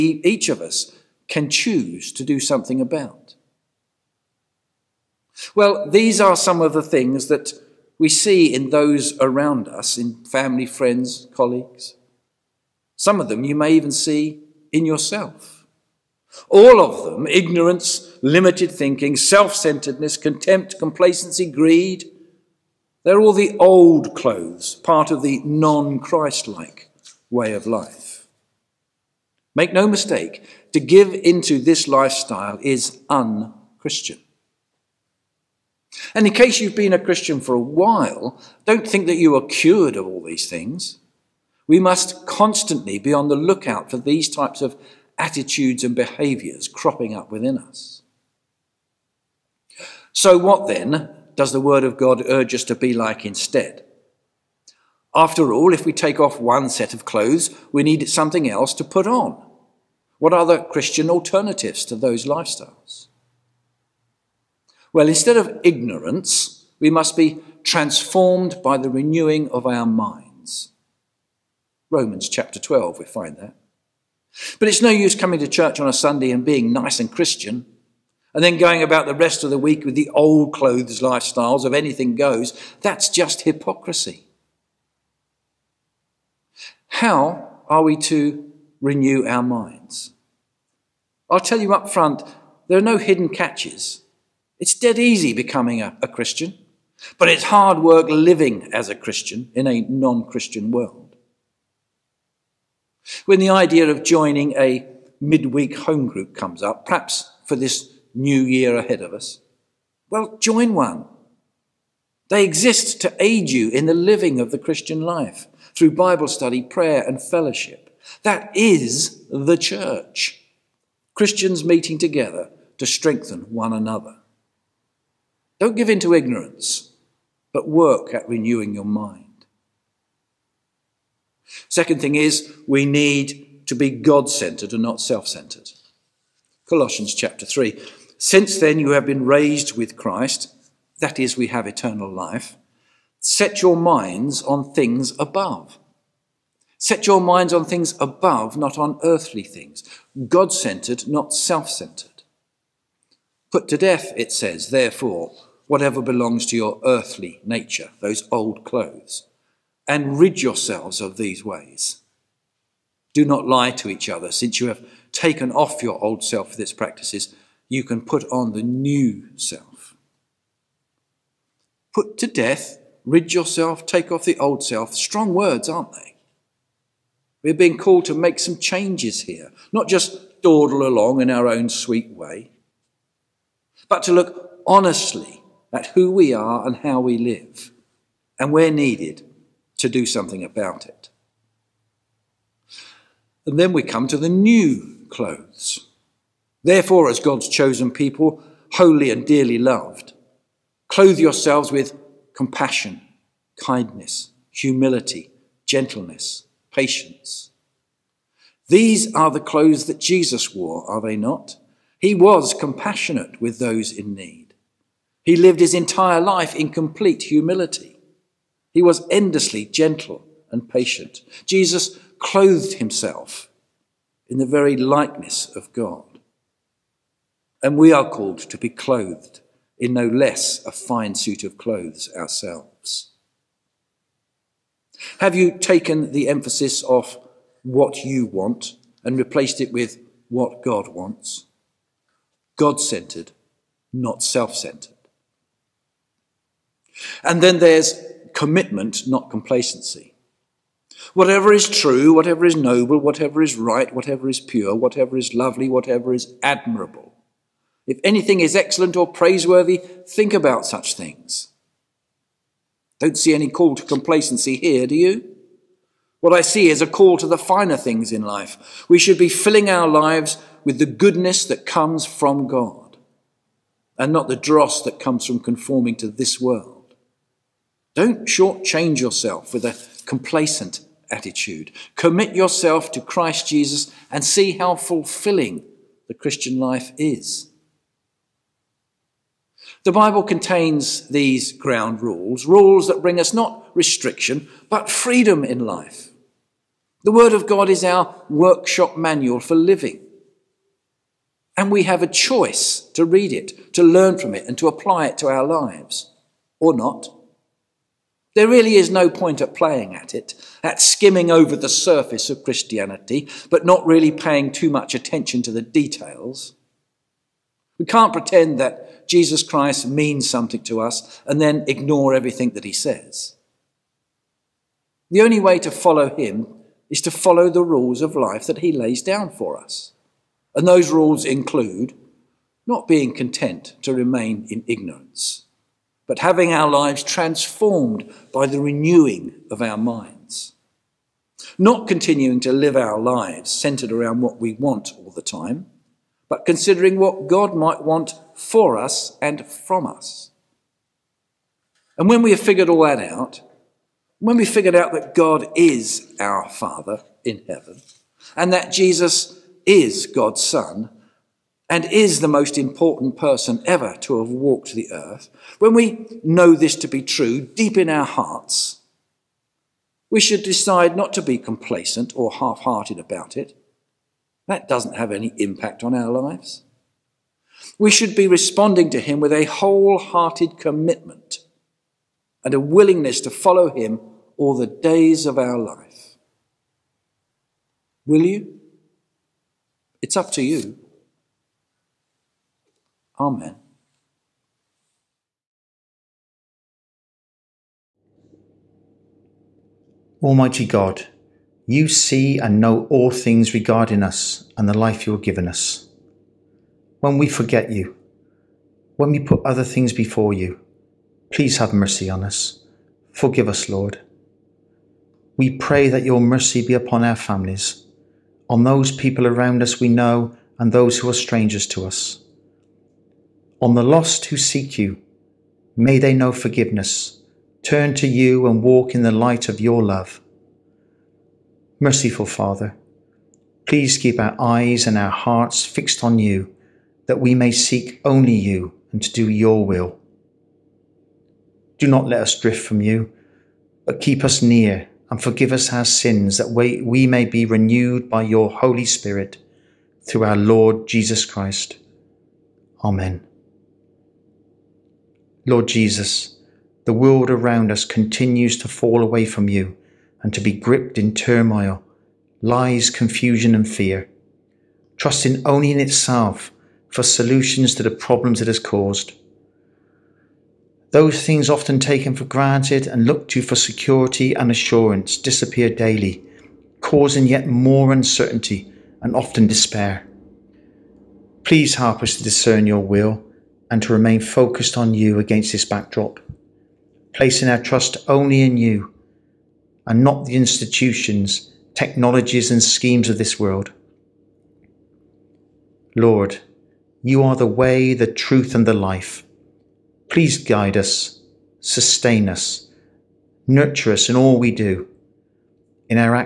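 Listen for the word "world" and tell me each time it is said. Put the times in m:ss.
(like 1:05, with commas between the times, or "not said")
1:40, 4:36, 7:36, 8:13.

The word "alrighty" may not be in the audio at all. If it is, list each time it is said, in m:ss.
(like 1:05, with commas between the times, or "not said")
not said.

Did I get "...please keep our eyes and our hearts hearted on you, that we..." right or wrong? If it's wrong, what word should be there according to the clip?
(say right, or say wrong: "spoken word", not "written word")
wrong: "fixed", not "hearted".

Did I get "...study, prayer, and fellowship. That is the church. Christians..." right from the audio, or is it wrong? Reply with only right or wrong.
right.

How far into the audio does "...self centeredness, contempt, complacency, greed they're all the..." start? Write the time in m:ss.
0:19.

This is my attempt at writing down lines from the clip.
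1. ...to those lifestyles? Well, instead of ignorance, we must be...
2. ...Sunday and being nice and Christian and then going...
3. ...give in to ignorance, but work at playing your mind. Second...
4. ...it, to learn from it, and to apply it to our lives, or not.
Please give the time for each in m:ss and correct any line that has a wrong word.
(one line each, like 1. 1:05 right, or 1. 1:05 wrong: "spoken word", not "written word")
1. 1:01 right
2. 1:15 right
3. 2:05 wrong: "renewing", not "playing"
4. 5:03 right.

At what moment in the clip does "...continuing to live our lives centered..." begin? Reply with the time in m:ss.
5:41.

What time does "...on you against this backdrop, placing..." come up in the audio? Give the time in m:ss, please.
8:04.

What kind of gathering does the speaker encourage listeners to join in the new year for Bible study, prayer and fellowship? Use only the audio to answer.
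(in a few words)
Midweek home group.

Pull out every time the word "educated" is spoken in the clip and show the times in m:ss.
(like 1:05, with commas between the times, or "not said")
not said.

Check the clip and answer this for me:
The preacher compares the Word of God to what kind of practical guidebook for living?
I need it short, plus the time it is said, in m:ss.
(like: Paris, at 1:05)
Workshop manual, at 4:58.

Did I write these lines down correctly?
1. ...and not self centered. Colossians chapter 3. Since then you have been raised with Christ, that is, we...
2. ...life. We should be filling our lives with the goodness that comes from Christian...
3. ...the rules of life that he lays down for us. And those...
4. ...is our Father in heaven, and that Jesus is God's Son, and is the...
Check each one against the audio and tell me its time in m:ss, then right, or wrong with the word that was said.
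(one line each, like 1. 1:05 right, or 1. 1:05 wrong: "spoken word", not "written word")
1. 2:14 right
2. 4:28 wrong: "God", not "Christian"
3. 5:27 right
4. 5:55 right.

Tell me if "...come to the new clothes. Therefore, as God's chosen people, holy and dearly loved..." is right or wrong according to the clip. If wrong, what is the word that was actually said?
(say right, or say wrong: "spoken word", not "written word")
right.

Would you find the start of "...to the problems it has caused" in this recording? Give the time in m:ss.
7:47.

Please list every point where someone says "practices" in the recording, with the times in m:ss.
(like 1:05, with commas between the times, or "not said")
2:46.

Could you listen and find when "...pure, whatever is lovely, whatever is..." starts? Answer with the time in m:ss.
4:14.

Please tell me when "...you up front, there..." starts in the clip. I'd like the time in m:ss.
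1:31.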